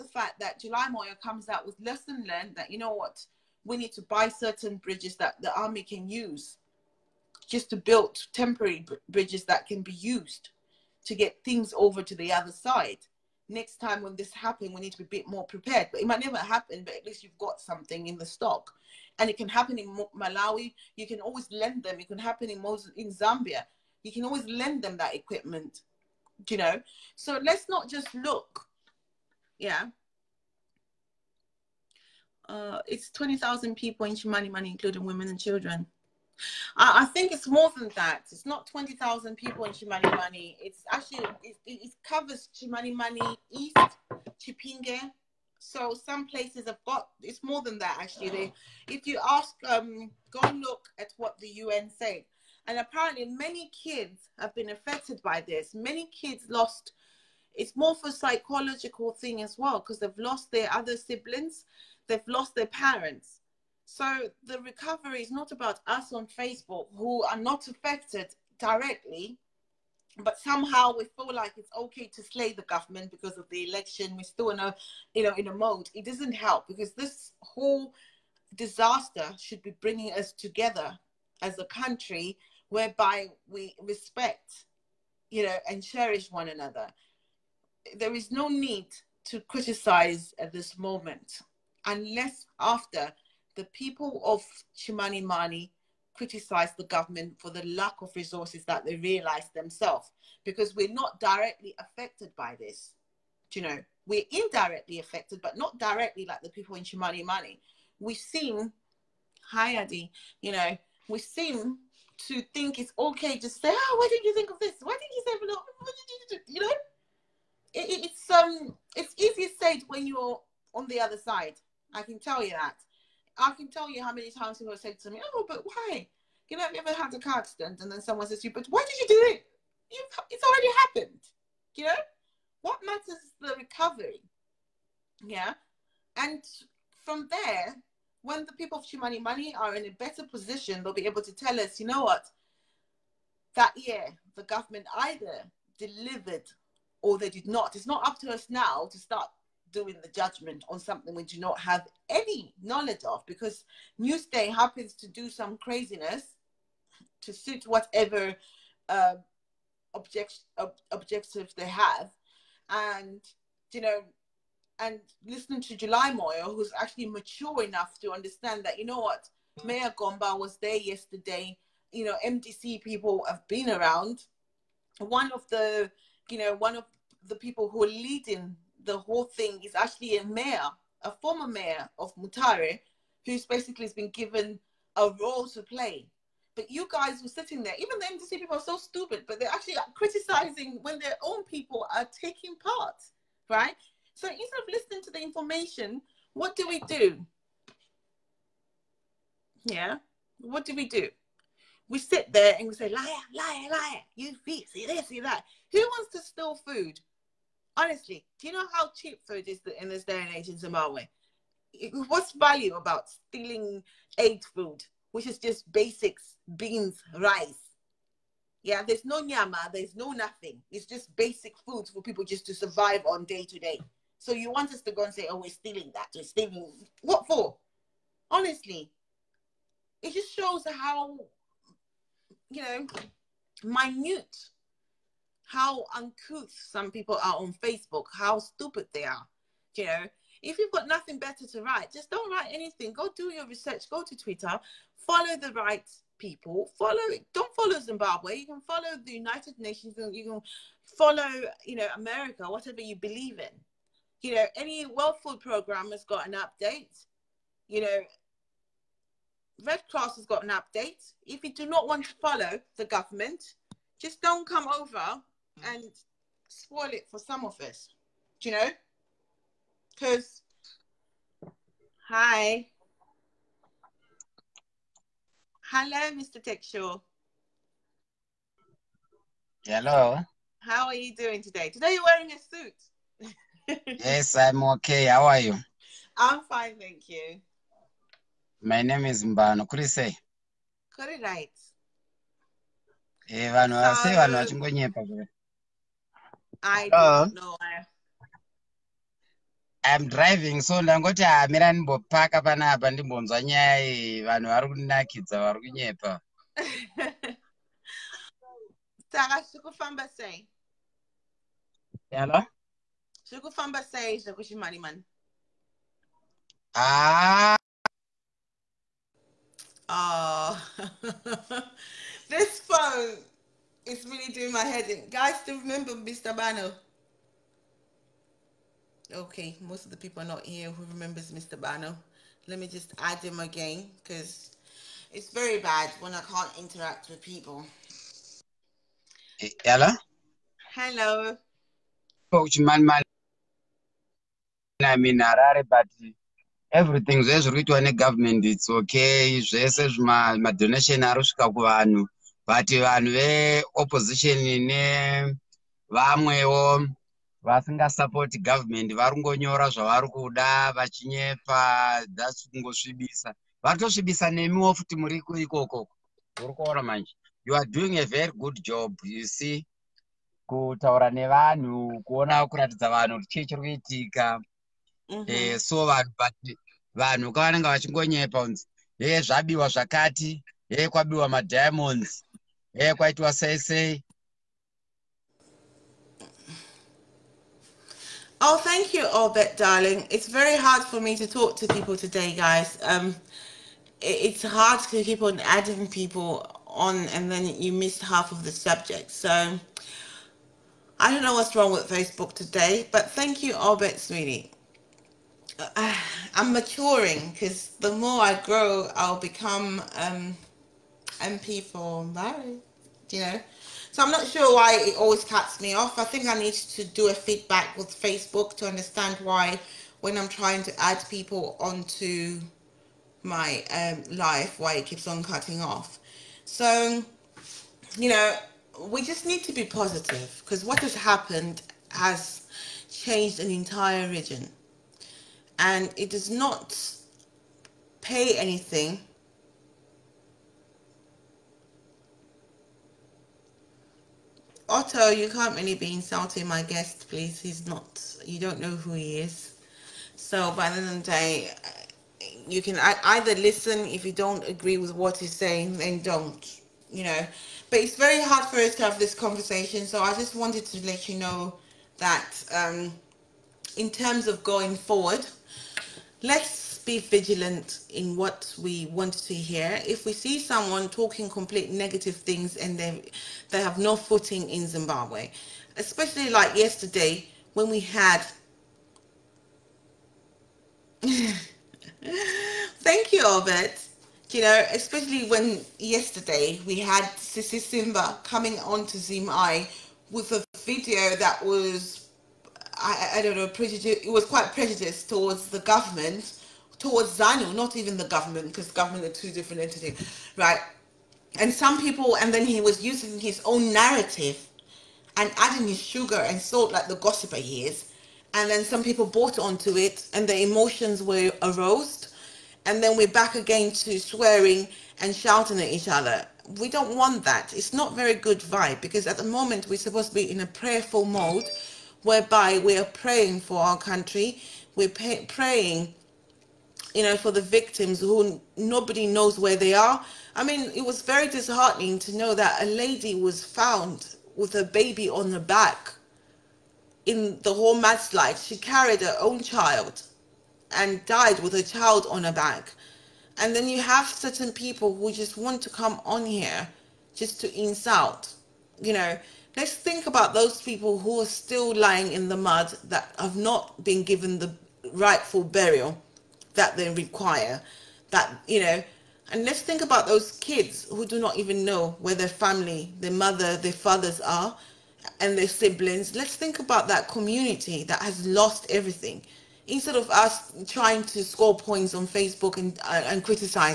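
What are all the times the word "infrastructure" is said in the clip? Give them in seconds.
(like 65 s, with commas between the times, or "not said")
not said.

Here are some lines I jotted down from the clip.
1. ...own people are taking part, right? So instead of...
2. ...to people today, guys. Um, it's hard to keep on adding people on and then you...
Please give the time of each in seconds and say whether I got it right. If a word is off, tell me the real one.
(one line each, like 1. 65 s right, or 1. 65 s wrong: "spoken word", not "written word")
1. 191 s right
2. 391 s right.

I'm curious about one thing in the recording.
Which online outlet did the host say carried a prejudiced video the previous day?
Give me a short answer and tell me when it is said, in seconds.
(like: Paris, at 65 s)
ZimEye, at 488 s.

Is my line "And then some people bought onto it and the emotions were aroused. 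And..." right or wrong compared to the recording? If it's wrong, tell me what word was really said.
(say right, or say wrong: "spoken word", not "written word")
right.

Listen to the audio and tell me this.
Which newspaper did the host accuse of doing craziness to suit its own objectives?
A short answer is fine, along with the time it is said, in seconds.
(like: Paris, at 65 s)
Newsday, at 154 s.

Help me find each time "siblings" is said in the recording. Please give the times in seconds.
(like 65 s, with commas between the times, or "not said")
60 s, 565 s.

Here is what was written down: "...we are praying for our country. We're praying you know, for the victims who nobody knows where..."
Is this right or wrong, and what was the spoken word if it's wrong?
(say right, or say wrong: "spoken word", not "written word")
right.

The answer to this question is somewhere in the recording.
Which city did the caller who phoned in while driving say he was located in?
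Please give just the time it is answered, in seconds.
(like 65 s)
345 s.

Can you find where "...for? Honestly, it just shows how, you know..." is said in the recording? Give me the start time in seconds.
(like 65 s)
227 s.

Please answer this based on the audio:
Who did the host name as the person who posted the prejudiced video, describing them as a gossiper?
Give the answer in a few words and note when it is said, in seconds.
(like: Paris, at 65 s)
Sisi Simba, at 487 s.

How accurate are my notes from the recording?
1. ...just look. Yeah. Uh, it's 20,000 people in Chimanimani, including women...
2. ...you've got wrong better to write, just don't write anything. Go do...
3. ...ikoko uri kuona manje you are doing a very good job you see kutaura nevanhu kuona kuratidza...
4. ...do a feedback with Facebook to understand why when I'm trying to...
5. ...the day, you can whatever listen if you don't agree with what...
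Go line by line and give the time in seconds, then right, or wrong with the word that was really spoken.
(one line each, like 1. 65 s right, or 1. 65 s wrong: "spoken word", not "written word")
1. 27 s right
2. 240 s wrong: "nothing", not "wrong"
3. 365 s right
4. 416 s right
5. 450 s wrong: "either", not "whatever".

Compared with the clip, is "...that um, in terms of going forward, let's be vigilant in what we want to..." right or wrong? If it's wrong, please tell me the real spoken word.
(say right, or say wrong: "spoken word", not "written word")
right.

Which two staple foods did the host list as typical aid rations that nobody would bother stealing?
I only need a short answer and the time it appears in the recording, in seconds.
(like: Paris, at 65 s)
Beans, rice, at 216 s.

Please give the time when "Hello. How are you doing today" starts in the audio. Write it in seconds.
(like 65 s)
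279 s.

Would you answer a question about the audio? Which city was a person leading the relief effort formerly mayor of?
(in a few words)
Mutare.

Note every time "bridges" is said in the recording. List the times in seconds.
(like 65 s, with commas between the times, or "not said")
4 s, 9 s.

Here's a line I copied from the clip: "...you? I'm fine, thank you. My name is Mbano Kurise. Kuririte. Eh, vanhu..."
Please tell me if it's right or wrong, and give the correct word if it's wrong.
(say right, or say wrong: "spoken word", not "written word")
right.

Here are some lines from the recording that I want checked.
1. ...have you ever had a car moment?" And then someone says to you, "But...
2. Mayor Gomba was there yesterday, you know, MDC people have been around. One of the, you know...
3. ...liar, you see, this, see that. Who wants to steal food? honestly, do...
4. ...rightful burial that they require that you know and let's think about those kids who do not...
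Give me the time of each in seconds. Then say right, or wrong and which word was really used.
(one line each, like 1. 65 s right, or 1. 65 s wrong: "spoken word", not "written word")
1. 126 s wrong: "accident", not "moment"
2. 169 s right
3. 203 s right
4. 554 s right.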